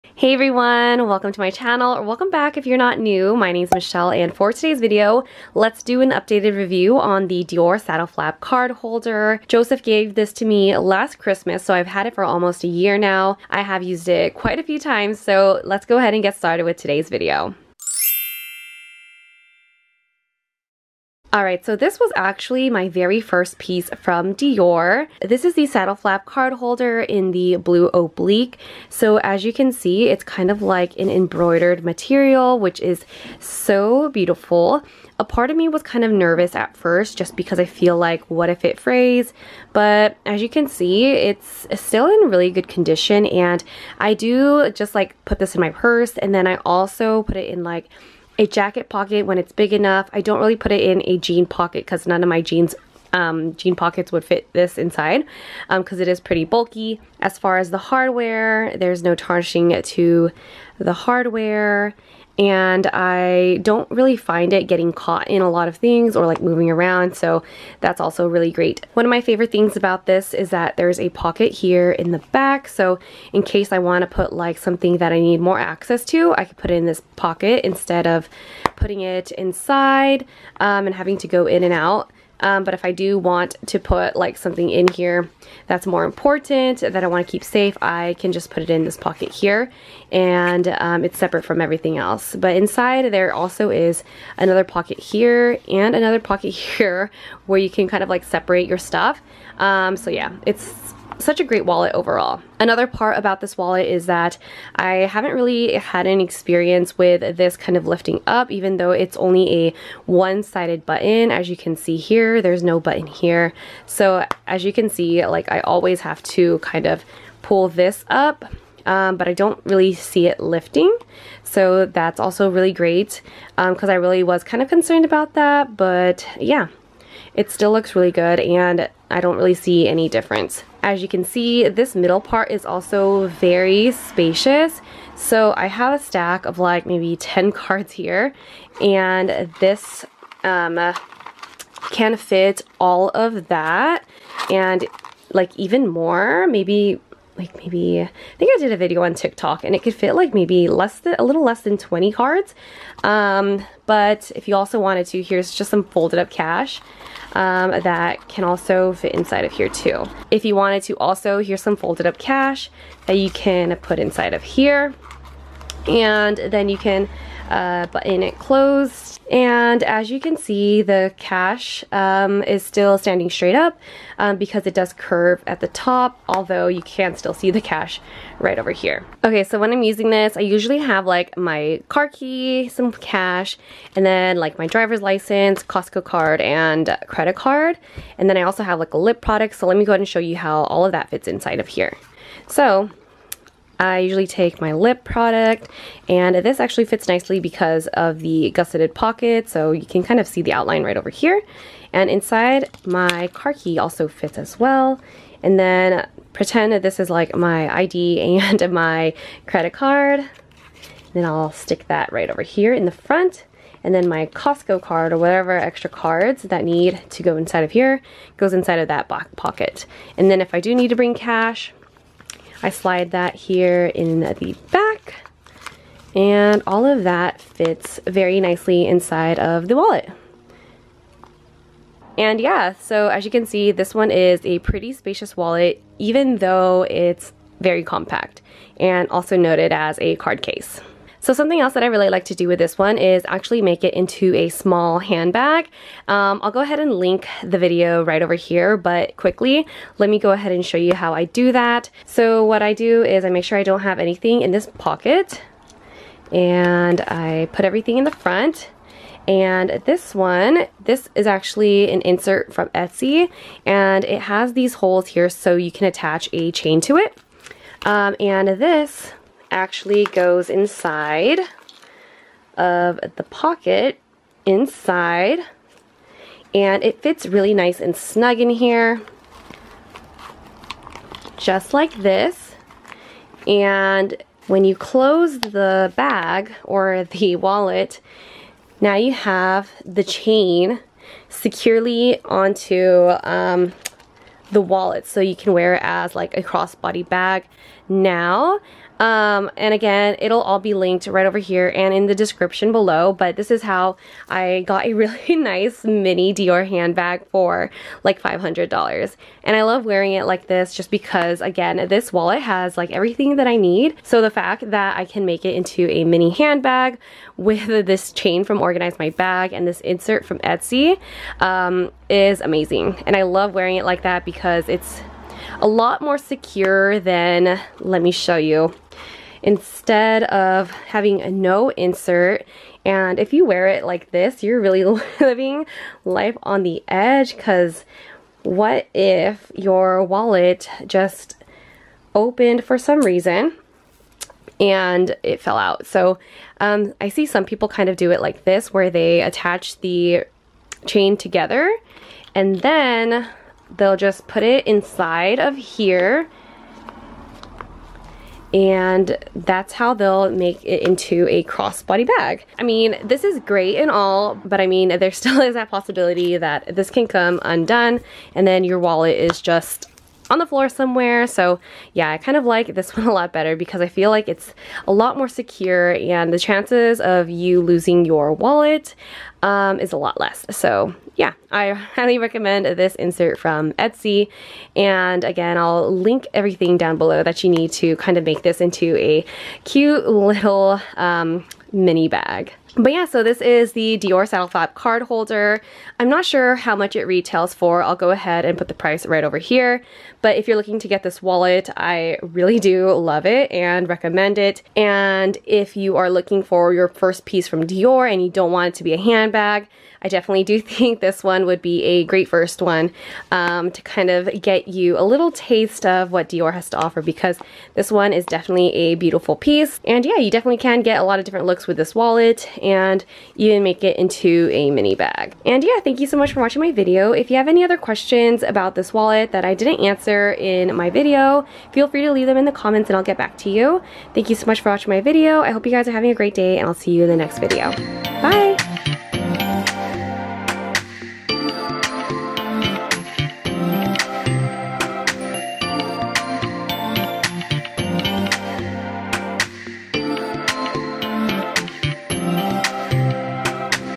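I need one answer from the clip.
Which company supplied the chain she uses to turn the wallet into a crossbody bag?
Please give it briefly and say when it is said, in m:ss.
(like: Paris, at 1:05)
Organize My Bag, at 5:18.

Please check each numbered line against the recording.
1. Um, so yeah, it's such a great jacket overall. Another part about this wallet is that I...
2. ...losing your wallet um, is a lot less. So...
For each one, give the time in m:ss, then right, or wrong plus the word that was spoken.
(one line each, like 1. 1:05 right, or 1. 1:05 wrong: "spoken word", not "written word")
1. 1:39 wrong: "wallet", not "jacket"
2. 6:17 right.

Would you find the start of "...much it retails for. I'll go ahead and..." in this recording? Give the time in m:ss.
6:36.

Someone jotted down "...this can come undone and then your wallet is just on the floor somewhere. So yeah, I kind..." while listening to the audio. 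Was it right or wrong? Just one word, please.
right.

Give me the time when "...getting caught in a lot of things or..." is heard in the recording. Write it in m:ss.
1:04.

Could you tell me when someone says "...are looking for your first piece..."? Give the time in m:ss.
6:45.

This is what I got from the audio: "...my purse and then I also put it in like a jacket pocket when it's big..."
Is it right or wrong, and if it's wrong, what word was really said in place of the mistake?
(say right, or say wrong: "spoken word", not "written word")
right.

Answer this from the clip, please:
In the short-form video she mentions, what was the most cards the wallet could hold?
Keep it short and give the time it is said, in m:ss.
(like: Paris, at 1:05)
less than 20, at 2:31.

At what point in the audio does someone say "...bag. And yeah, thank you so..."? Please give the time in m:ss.
7:04.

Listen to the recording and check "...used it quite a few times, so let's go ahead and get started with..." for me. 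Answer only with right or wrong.
right.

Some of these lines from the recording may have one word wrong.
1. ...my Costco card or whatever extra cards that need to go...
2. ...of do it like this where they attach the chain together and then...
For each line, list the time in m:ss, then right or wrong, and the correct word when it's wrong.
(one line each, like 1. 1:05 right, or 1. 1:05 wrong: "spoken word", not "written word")
1. 3:34 right
2. 5:47 right.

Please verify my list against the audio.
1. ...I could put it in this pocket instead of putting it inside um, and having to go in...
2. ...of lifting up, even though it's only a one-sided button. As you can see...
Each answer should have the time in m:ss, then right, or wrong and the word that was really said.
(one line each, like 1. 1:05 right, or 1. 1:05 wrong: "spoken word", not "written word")
1. 1:16 right
2. 1:47 right.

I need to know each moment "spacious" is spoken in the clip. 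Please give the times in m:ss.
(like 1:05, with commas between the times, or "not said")
2:13, 3:54.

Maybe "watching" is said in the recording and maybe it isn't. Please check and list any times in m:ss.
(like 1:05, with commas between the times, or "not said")
7:06, 7:14.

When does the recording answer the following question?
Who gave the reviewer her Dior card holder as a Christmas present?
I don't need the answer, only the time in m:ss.
0:09.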